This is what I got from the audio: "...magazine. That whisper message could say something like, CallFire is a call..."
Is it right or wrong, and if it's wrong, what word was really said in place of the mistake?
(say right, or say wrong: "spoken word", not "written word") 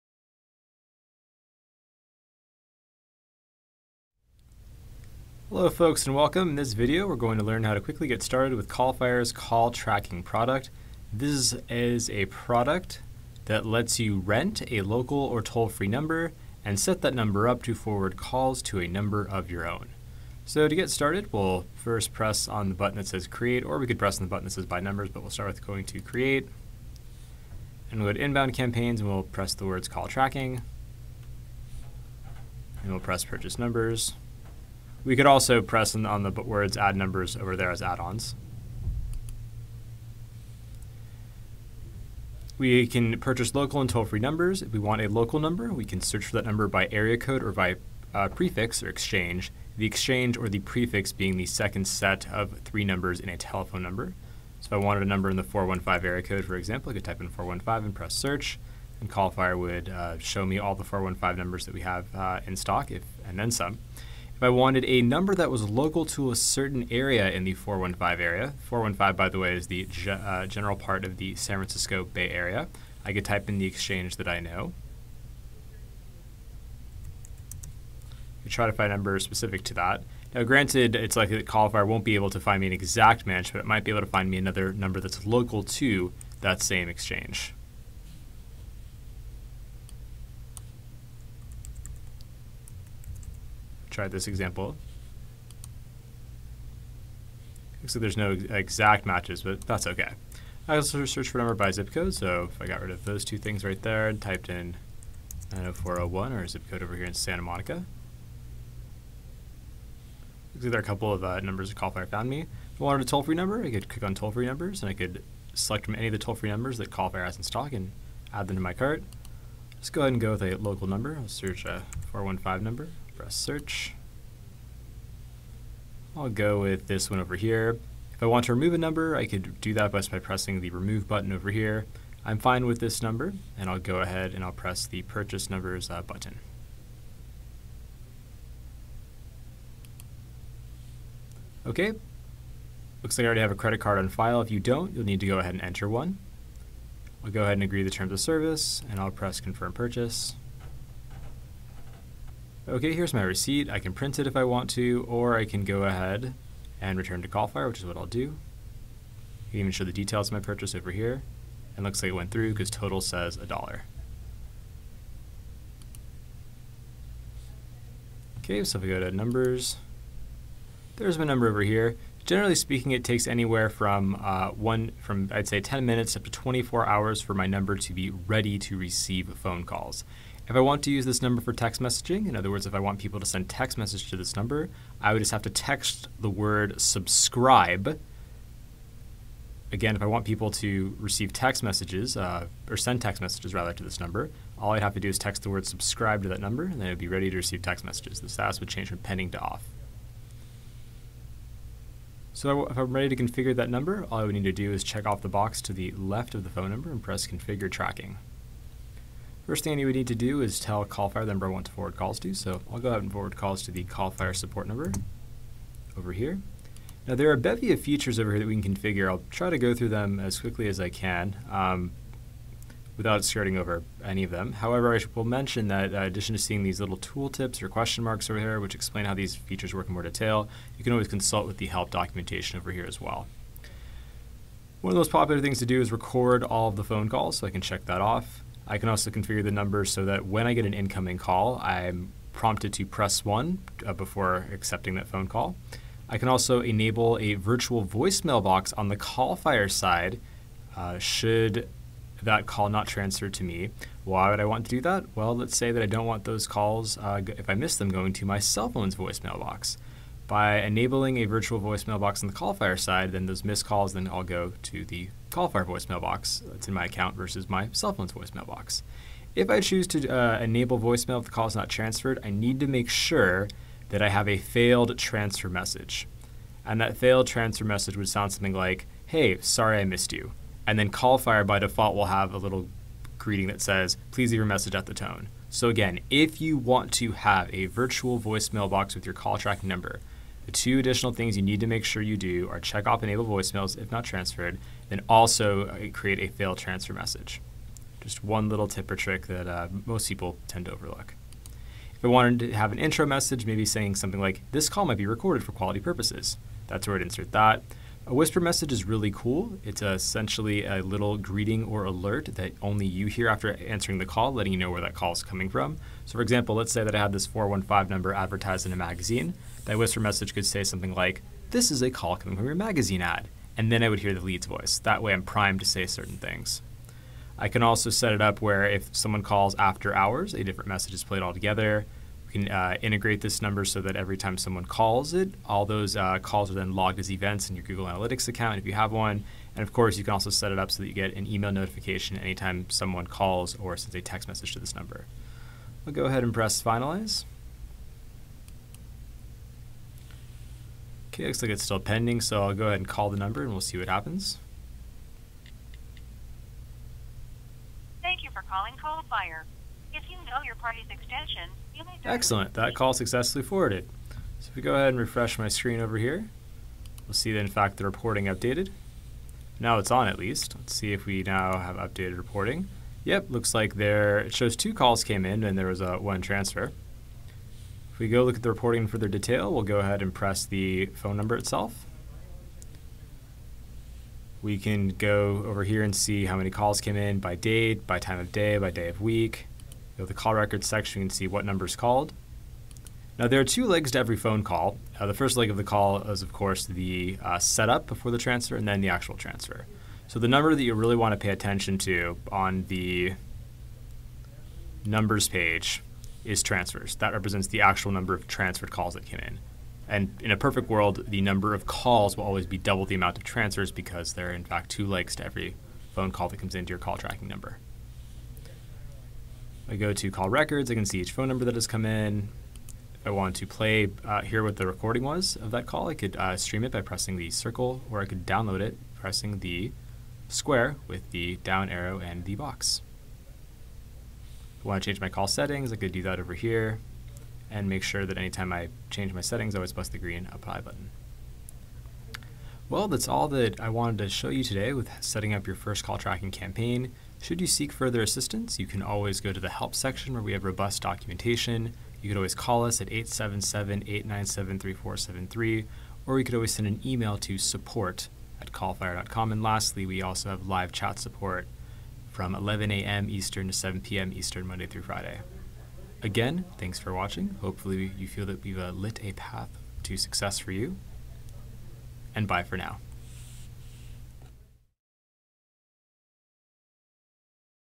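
wrong: "This", not "CallFire".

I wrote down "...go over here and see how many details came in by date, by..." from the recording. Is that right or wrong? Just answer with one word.
wrong.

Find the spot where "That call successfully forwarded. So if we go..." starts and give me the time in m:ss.
6:02.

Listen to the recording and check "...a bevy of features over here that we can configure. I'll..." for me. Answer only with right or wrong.
right.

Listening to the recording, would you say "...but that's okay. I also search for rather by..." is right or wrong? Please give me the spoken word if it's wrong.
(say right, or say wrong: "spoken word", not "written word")
wrong: "number", not "rather".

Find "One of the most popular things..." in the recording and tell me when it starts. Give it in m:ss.
3:54.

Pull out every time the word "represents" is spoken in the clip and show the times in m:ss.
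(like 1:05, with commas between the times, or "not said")
6:47.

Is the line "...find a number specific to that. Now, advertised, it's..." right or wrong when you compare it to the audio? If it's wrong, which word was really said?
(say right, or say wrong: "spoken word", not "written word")
wrong: "granted", not "advertised".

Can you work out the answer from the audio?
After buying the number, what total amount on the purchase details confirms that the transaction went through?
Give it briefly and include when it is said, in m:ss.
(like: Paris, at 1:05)
a dollar, at 2:43.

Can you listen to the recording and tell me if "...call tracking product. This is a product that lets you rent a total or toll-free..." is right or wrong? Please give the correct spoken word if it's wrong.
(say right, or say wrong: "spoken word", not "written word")
wrong: "local", not "total".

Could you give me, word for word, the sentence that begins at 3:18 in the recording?
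The status would change from pending to off.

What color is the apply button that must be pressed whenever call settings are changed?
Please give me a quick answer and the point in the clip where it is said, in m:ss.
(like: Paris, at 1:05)
green, at 7:19.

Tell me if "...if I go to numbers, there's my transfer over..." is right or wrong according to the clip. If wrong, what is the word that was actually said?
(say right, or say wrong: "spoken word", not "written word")
wrong: "number", not "transfer".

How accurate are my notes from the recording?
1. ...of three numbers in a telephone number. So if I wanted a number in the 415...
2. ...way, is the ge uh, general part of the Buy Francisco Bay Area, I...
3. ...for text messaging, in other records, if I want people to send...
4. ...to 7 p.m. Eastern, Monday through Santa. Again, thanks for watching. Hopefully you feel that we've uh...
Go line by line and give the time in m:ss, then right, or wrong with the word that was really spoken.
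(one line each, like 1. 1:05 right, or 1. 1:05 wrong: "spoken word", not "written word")
1. 0:52 right
2. 1:09 wrong: "San", not "Buy"
3. 3:01 wrong: "words", not "records"
4. 7:43 wrong: "Friday", not "Santa".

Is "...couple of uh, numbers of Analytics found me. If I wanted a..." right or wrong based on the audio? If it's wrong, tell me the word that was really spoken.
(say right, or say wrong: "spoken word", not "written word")
wrong: "Callfire", not "Analytics".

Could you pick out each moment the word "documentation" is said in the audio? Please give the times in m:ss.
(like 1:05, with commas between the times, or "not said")
3:51, 7:30.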